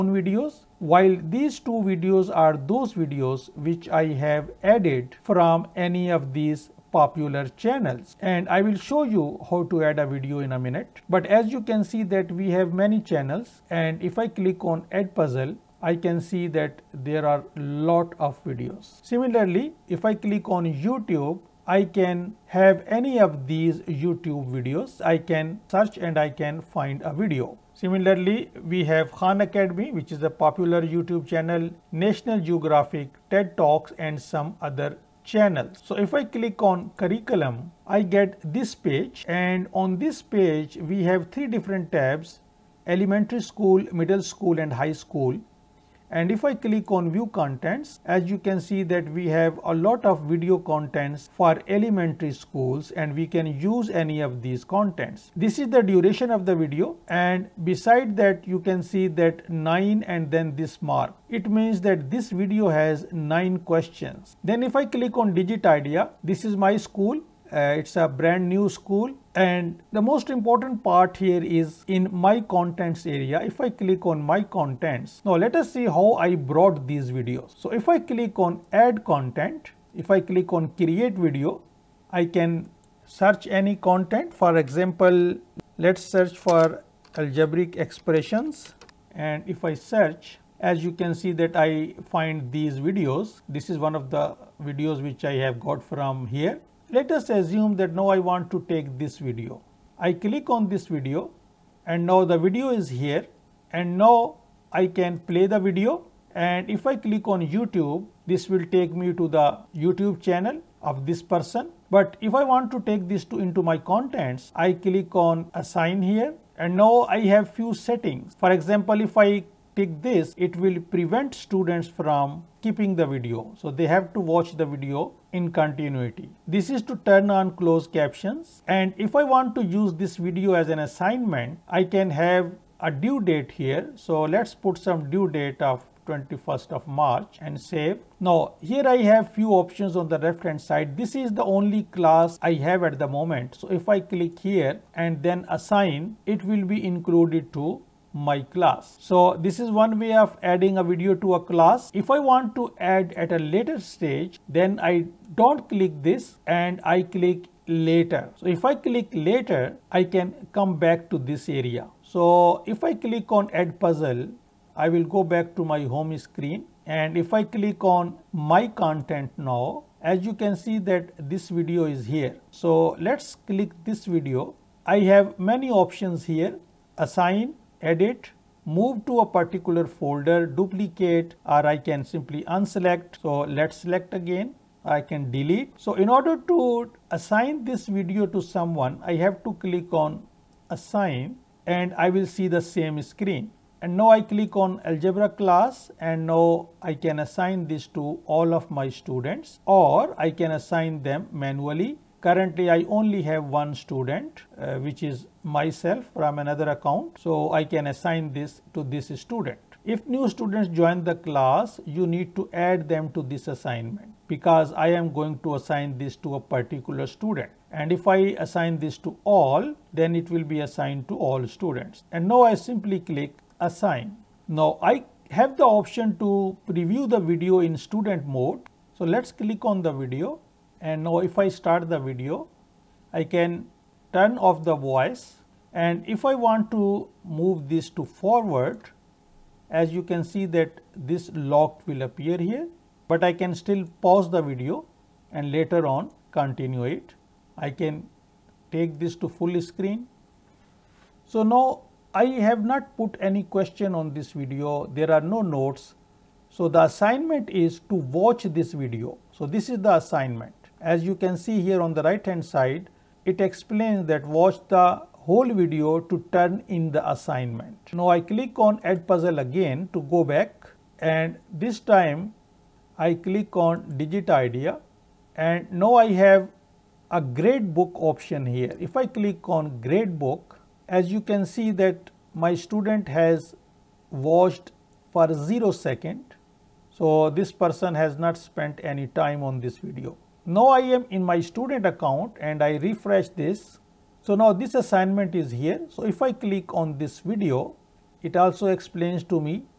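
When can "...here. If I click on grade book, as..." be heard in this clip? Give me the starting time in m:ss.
4:38.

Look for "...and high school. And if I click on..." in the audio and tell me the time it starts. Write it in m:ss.
0:44.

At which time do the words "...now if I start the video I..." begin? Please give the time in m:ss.
3:51.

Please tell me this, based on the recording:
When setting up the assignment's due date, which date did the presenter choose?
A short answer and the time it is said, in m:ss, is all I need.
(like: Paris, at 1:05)
21st of March, at 2:16.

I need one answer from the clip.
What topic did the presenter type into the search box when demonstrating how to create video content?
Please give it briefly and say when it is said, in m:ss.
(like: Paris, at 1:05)
algebraic expressions, at 1:27.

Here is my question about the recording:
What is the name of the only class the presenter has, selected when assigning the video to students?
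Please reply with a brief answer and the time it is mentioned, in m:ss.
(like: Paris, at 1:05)
algebra class, at 3:14.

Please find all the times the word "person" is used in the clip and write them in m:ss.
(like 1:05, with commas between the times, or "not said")
1:51, 4:47.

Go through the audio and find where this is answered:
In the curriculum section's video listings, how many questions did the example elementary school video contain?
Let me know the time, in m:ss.
1:01.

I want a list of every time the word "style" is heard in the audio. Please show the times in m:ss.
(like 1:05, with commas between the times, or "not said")
not said.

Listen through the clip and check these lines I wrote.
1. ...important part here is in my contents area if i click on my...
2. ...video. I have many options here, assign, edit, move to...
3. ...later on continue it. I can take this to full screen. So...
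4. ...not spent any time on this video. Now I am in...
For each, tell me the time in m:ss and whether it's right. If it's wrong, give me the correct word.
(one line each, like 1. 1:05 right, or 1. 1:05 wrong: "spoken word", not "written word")
1. 1:10 right
2. 2:54 right
3. 4:05 right
4. 4:48 right.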